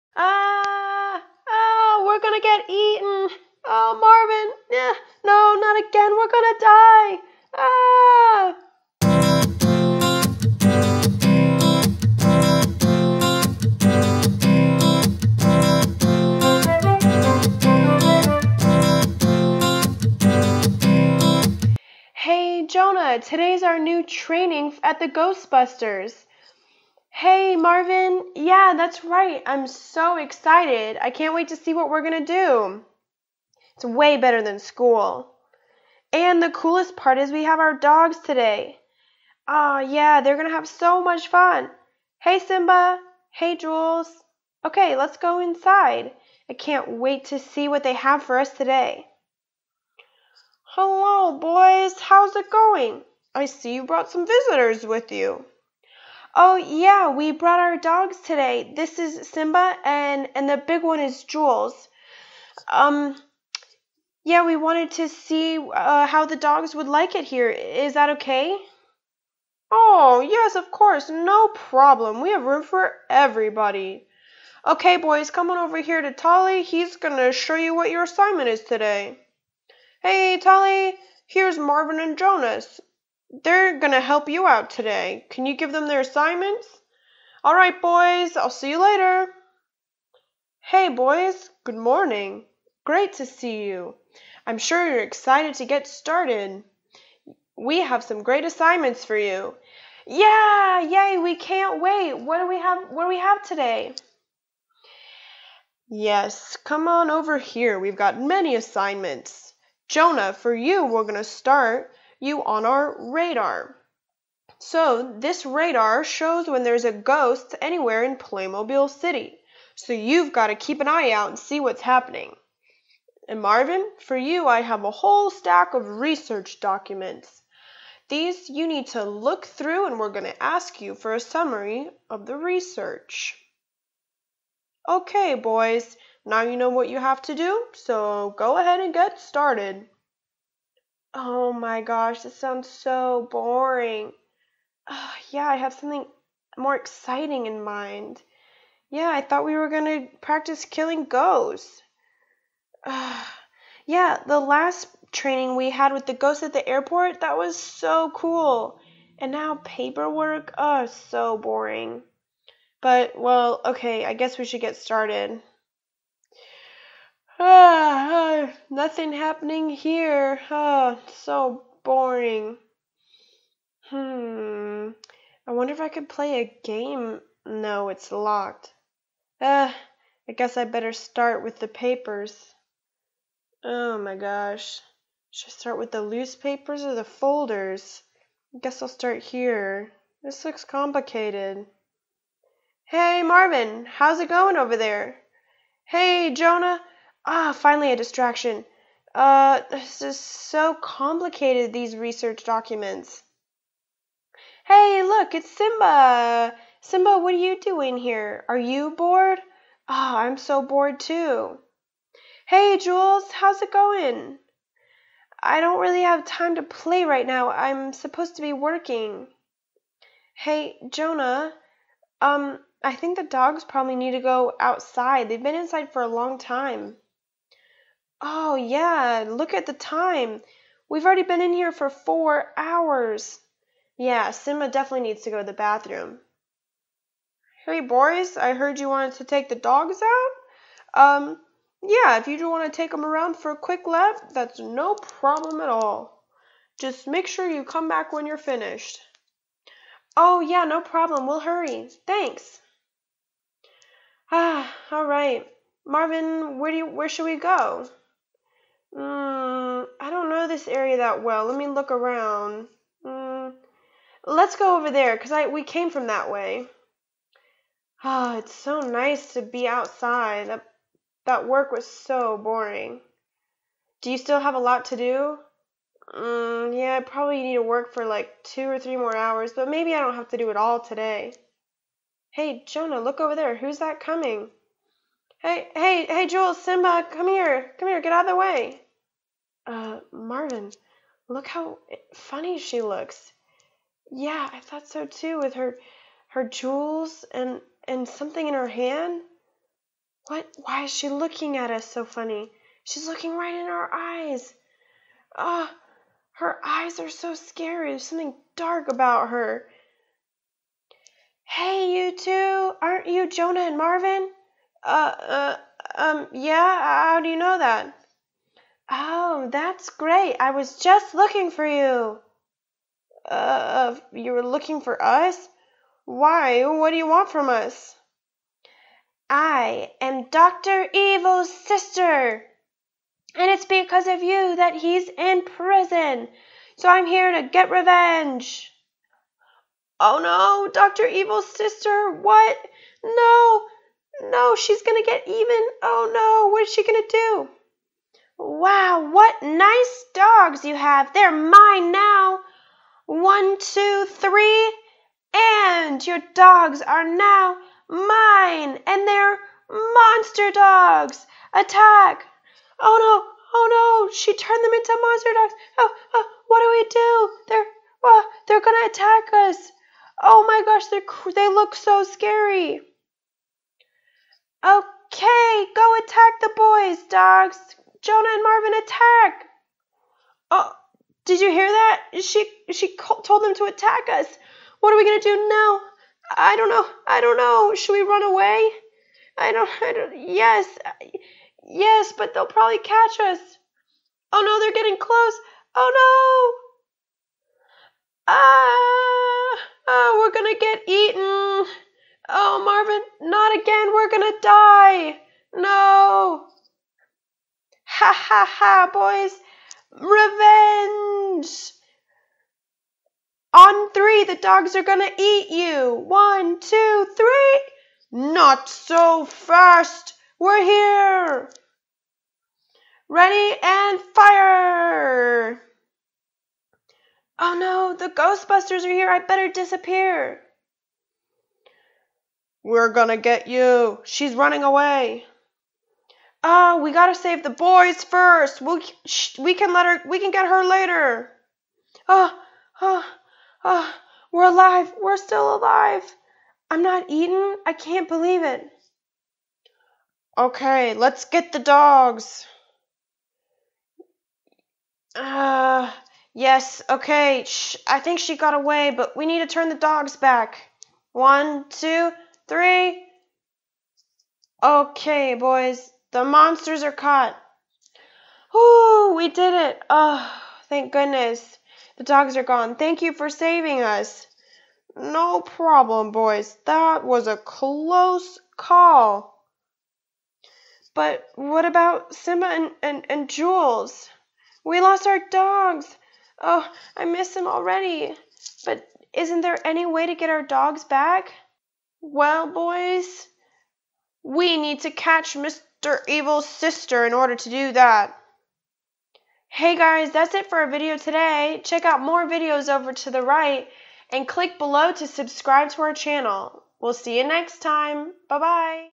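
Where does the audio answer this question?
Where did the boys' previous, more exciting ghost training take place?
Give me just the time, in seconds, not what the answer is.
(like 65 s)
156 s.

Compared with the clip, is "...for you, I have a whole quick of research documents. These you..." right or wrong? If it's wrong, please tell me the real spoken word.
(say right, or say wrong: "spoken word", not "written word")
wrong: "stack", not "quick".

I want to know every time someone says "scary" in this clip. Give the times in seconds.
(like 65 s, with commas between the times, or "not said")
307 s, 372 s.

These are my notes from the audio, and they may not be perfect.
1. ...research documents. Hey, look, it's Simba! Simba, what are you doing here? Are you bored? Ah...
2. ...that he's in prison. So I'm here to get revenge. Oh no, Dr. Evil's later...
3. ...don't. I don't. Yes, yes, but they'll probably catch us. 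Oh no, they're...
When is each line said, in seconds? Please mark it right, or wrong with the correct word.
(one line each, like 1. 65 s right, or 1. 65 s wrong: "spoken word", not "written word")
1. 201 s right
2. 334 s wrong: "sister", not "later"
3. 389 s right.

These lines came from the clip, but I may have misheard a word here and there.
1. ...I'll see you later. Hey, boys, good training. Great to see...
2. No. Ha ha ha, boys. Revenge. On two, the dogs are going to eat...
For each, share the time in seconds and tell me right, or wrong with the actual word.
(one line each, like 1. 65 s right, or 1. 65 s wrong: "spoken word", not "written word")
1. 88 s wrong: "morning", not "training"
2. 405 s wrong: "three", not "two".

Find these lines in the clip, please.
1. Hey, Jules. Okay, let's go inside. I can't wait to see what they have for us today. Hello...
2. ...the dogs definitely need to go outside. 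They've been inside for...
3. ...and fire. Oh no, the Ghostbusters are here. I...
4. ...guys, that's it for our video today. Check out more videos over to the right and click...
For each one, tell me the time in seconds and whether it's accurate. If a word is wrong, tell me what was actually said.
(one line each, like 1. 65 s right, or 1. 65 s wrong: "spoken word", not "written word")
1. 43 s right
2. 223 s wrong: "probably", not "definitely"
3. 423 s right
4. 499 s right.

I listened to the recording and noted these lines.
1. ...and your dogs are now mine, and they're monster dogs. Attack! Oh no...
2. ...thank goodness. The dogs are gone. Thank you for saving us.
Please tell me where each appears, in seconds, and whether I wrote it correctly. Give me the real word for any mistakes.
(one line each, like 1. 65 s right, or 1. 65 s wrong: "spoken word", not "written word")
1. 355 s right
2. 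470 s right.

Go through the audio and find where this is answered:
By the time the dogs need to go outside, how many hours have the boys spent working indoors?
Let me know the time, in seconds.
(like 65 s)
231 s.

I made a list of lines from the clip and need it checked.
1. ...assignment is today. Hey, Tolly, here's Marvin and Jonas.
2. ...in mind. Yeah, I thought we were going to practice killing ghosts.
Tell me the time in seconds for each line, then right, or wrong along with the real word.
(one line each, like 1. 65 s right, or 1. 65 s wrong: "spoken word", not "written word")
1. 78 s right
2. 147 s right.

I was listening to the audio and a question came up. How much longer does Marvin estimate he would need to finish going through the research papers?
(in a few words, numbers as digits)
2 or 3 hours.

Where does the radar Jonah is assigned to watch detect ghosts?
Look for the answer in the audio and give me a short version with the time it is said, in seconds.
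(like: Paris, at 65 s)
Playmobil City, at 118 s.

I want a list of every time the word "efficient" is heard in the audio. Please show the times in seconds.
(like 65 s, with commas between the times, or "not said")
not said.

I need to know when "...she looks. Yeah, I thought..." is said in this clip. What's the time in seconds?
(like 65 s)
292 s.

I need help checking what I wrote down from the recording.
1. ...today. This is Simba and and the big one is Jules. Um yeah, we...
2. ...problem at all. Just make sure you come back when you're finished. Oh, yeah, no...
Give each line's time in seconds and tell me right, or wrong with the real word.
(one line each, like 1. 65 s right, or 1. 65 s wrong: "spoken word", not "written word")
1. 58 s right
2. 244 s right.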